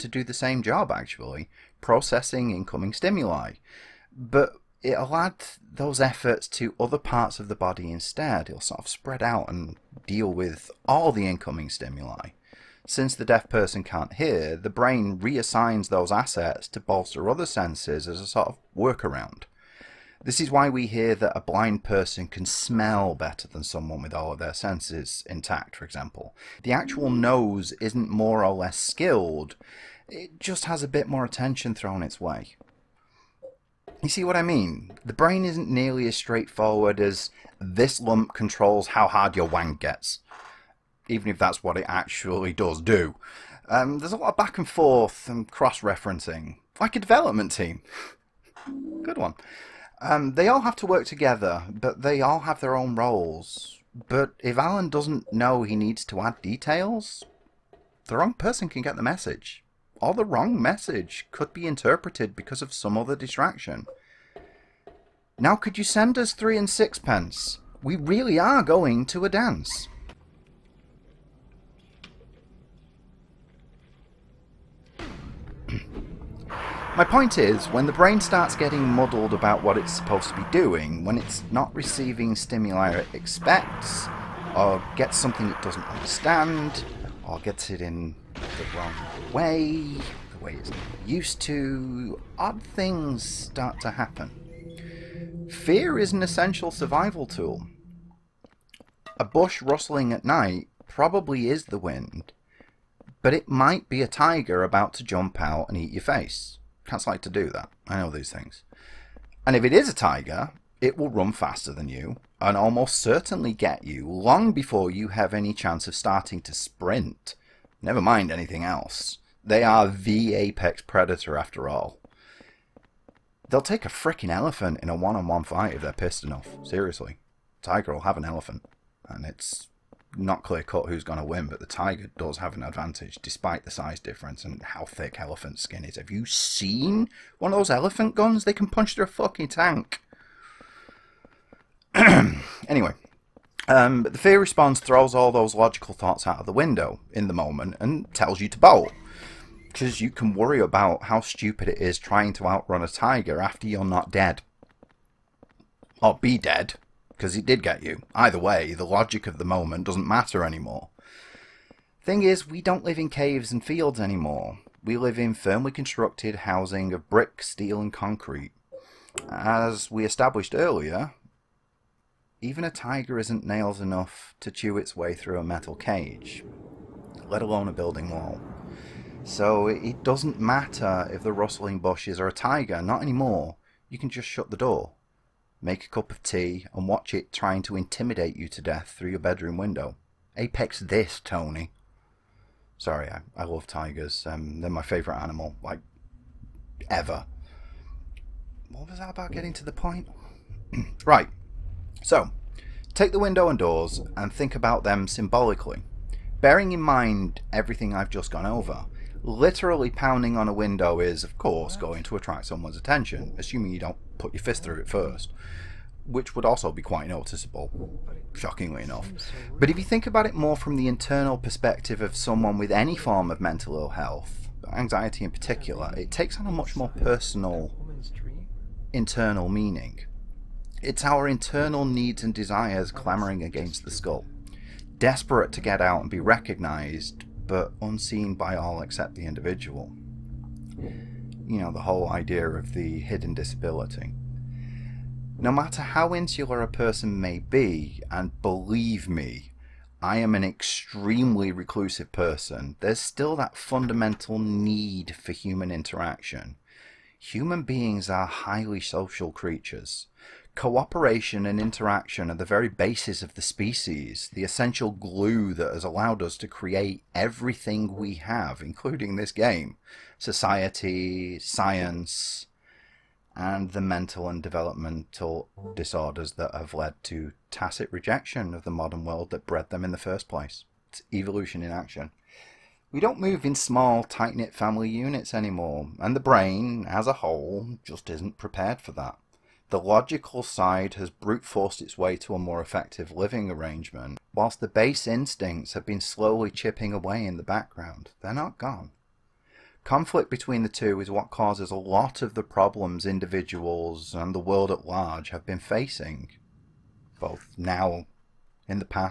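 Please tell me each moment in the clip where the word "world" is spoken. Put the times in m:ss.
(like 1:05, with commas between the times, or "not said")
4:39, 5:04.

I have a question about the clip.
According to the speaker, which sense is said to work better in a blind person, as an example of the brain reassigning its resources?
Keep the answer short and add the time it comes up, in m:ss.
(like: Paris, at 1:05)
smell, at 0:22.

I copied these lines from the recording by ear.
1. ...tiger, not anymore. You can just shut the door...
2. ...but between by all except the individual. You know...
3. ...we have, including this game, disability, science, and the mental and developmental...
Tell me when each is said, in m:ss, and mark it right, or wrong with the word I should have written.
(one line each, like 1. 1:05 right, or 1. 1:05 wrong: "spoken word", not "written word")
1. 3:02 right
2. 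3:57 wrong: "unseen", not "between"
3. 4:27 wrong: "society", not "disability".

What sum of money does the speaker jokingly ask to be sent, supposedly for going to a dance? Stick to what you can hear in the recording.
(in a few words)
three and sixpence.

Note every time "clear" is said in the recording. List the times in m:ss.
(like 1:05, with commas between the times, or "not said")
2:10.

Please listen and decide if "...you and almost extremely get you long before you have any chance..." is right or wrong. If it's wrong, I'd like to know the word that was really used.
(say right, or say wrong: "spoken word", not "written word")
wrong: "certainly", not "extremely".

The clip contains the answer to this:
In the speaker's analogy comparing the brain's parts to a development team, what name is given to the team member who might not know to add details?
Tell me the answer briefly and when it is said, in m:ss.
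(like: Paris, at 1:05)
Alan, at 0:54.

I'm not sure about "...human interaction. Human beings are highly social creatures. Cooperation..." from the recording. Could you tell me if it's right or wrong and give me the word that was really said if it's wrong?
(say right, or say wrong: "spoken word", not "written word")
right.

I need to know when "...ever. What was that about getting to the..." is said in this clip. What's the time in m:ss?
3:16.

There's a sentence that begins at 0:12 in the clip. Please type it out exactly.
Since the deaf person can't hear, the brain reassigns those assets to bolster other senses as a sort of workaround.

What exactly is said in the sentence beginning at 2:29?
Because you can worry about how stupid it is trying to outrun a tiger after you're not dead.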